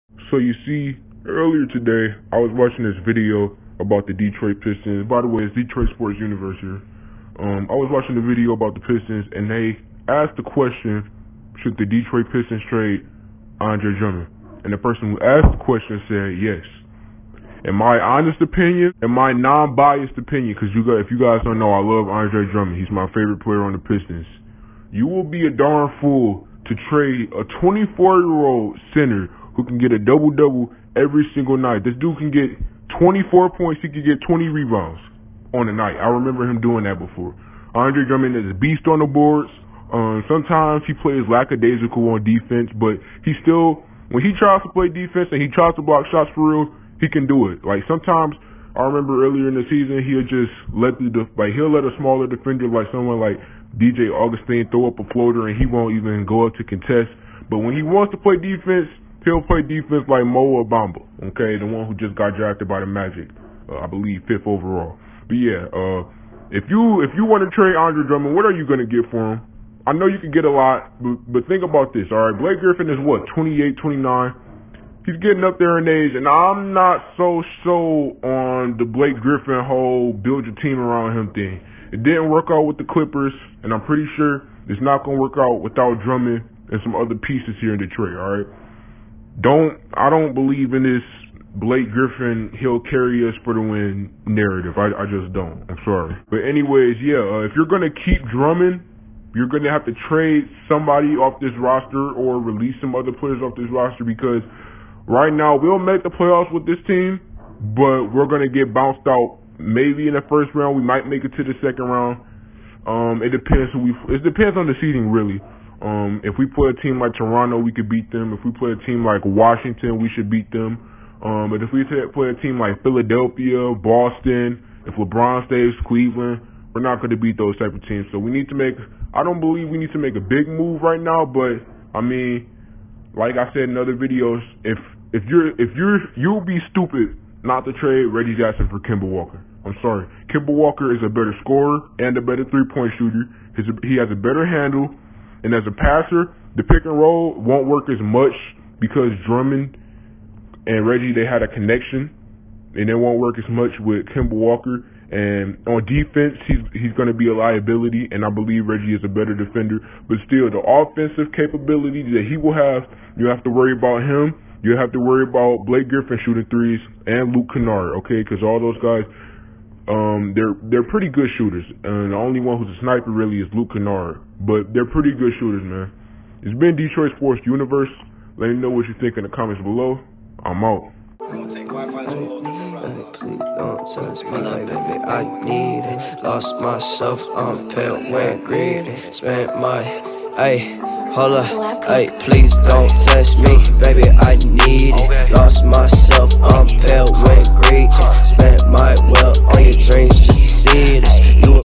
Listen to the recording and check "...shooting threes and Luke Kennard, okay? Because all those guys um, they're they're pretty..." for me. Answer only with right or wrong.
right.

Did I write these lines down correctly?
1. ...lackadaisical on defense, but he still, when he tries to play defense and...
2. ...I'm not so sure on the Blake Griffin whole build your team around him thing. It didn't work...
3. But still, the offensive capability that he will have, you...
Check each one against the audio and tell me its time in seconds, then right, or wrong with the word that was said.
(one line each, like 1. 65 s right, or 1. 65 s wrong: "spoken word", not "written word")
1. 41 s right
2. 76 s right
3. 160 s right.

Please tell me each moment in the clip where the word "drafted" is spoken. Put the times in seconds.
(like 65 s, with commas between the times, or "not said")
62 s.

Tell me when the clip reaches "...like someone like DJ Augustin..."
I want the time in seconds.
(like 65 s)
52 s.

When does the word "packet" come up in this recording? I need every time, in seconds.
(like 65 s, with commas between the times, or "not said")
not said.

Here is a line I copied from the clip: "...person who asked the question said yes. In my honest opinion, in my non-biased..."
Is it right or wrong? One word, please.
right.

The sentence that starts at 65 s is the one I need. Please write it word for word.
But yeah, uh, if you if you want to trade Andre Drummond, what are you going to get for him?